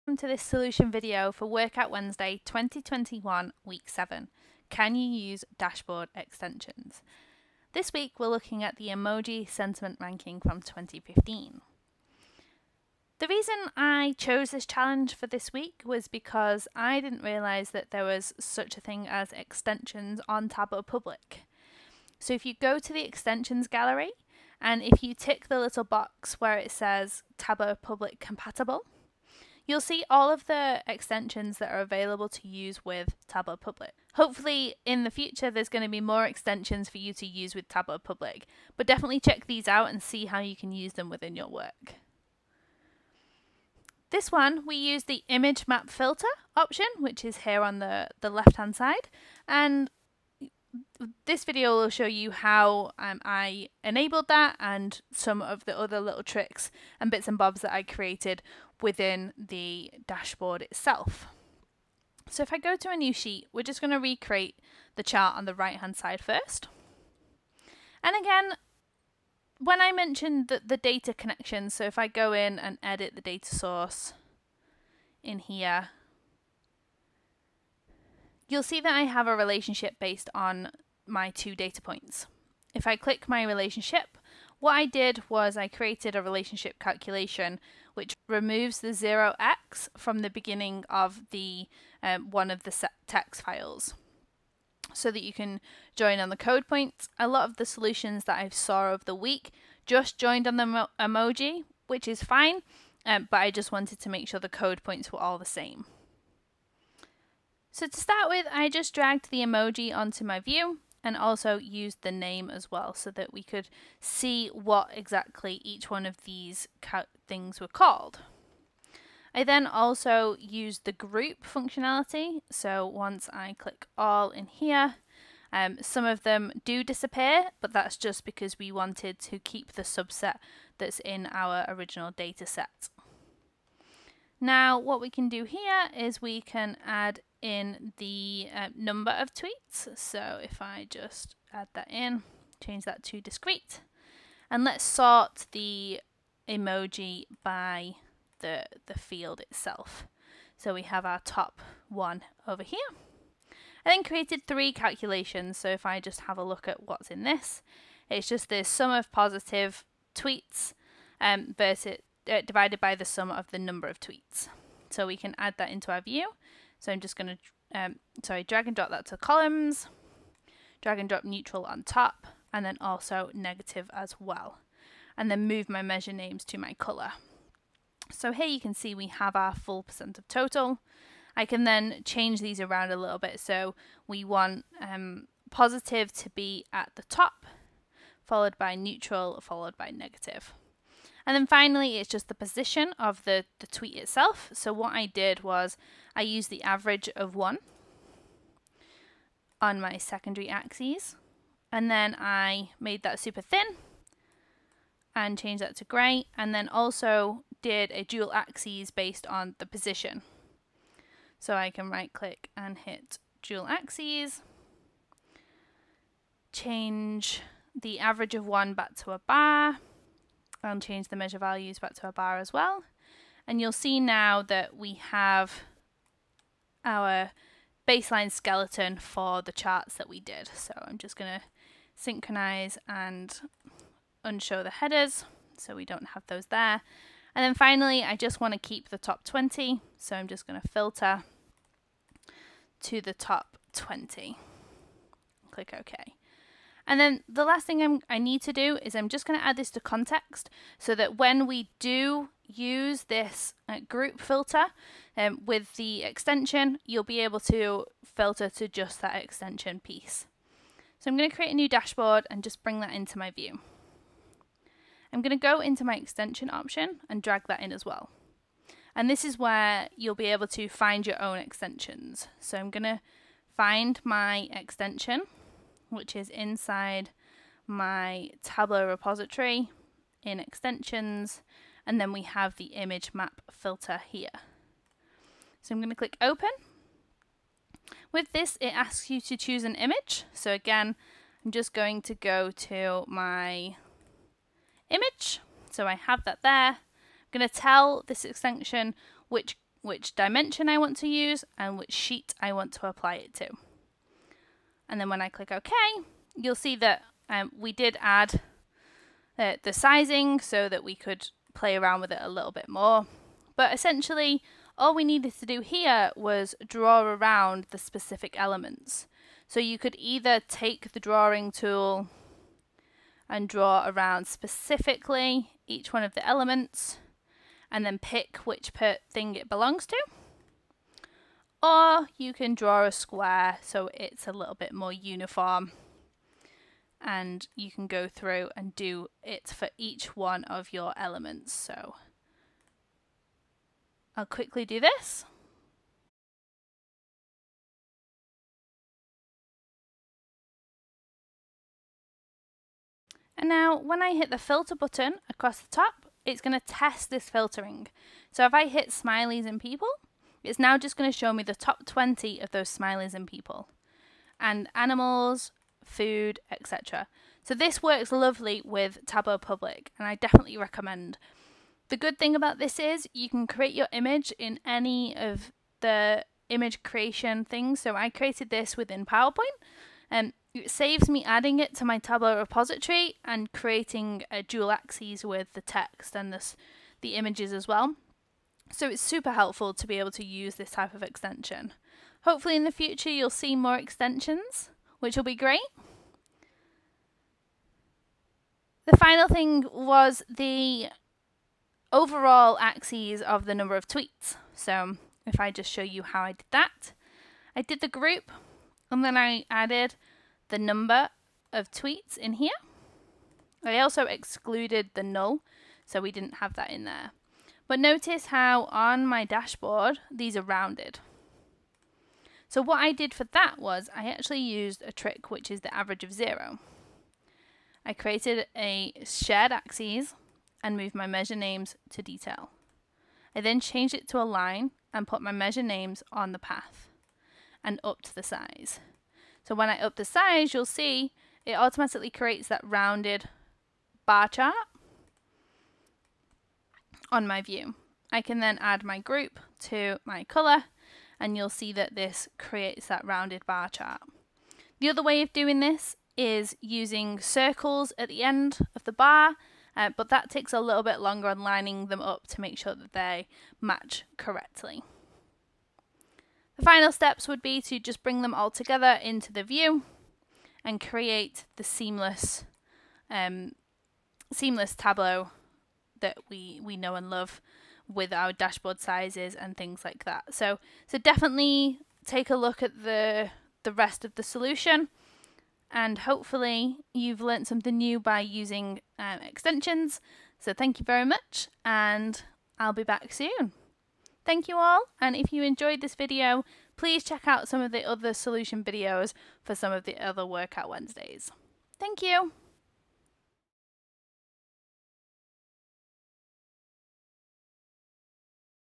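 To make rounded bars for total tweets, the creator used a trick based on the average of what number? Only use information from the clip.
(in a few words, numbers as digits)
0.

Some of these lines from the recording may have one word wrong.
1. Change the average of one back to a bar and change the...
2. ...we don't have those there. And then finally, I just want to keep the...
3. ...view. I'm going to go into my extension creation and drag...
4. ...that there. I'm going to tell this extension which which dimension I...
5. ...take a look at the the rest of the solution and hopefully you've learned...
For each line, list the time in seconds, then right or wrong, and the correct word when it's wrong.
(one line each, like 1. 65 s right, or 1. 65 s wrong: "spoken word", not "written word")
1. 216 s right
2. 235 s right
3. 263 s wrong: "option", not "creation"
4. 296 s right
5. 482 s right.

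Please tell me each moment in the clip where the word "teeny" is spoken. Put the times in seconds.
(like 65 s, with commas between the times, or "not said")
not said.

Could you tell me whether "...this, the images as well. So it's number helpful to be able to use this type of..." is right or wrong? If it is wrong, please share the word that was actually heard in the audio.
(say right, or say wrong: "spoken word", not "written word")
wrong: "super", not "number".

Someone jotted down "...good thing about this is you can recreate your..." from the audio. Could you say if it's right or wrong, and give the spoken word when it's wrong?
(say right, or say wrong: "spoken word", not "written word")
wrong: "create", not "recreate".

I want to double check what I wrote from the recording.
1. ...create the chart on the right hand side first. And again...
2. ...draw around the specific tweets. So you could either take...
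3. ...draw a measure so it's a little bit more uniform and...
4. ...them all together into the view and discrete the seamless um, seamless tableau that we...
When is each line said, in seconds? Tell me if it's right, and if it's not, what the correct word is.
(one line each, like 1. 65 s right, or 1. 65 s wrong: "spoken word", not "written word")
1. 63 s wrong: "recreate", not "create"
2. 316 s wrong: "elements", not "tweets"
3. 332 s wrong: "square", not "measure"
4. 468 s wrong: "create", not "discrete".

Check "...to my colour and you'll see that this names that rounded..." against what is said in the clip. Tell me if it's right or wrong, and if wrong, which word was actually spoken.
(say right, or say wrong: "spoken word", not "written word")
wrong: "creates", not "names".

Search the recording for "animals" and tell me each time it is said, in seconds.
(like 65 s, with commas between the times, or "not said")
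364 s.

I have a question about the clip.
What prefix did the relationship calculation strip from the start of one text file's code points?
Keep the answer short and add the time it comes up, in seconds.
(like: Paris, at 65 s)
0x, at 88 s.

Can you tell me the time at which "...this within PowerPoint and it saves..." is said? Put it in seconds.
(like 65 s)
378 s.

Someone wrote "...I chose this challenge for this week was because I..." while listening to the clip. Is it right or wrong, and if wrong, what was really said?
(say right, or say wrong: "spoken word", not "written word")
right.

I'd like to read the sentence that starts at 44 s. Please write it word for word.
This one, we use the image map filter option, which is here on the, the left-hand side.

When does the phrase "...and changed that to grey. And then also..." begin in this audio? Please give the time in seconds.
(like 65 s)
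205 s.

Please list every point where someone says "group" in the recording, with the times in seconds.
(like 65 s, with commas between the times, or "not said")
120 s, 253 s, 407 s, 448 s.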